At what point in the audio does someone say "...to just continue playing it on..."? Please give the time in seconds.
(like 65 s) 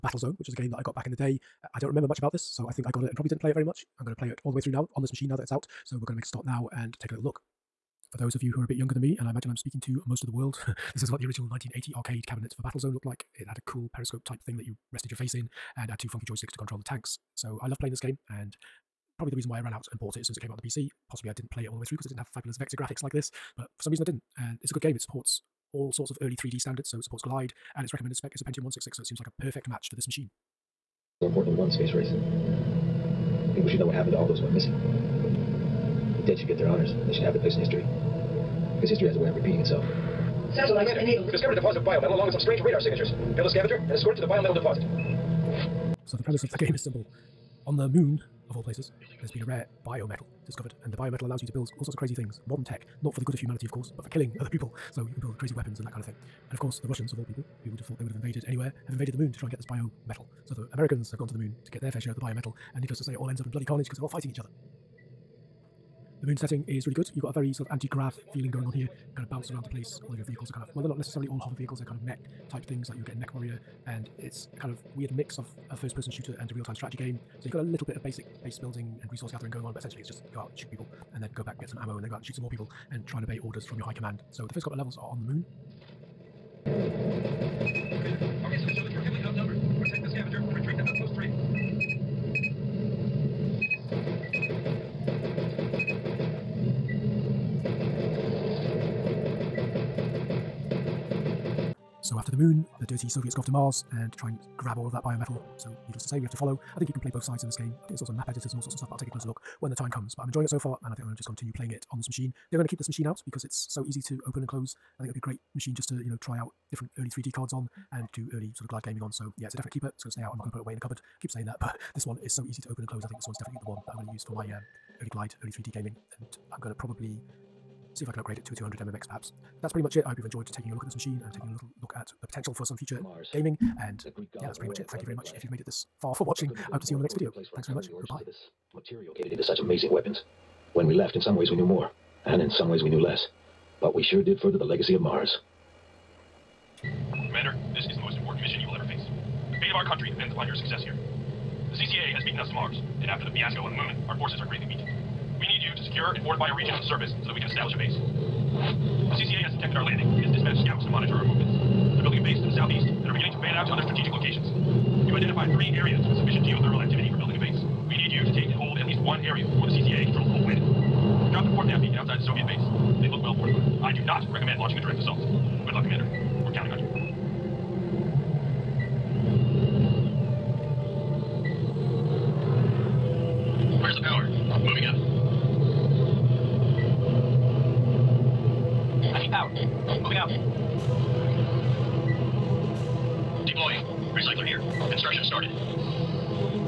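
111 s.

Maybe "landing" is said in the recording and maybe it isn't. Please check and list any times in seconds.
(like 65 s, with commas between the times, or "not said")
159 s.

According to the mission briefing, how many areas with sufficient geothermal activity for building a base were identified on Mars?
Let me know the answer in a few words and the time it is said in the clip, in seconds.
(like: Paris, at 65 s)
3, at 165 s.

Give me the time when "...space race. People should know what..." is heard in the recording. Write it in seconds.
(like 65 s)
31 s.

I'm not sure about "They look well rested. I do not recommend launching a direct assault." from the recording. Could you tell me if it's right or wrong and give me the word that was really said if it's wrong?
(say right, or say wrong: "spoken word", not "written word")
wrong: "fortified", not "rested".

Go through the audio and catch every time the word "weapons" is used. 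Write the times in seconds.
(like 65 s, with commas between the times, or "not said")
55 s, 139 s.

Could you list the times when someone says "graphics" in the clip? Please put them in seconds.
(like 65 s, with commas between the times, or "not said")
22 s.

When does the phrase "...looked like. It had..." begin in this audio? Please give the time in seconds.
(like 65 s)
12 s.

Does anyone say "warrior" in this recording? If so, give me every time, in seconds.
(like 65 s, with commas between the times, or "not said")
73 s.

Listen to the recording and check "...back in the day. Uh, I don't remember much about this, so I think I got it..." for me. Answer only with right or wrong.
right.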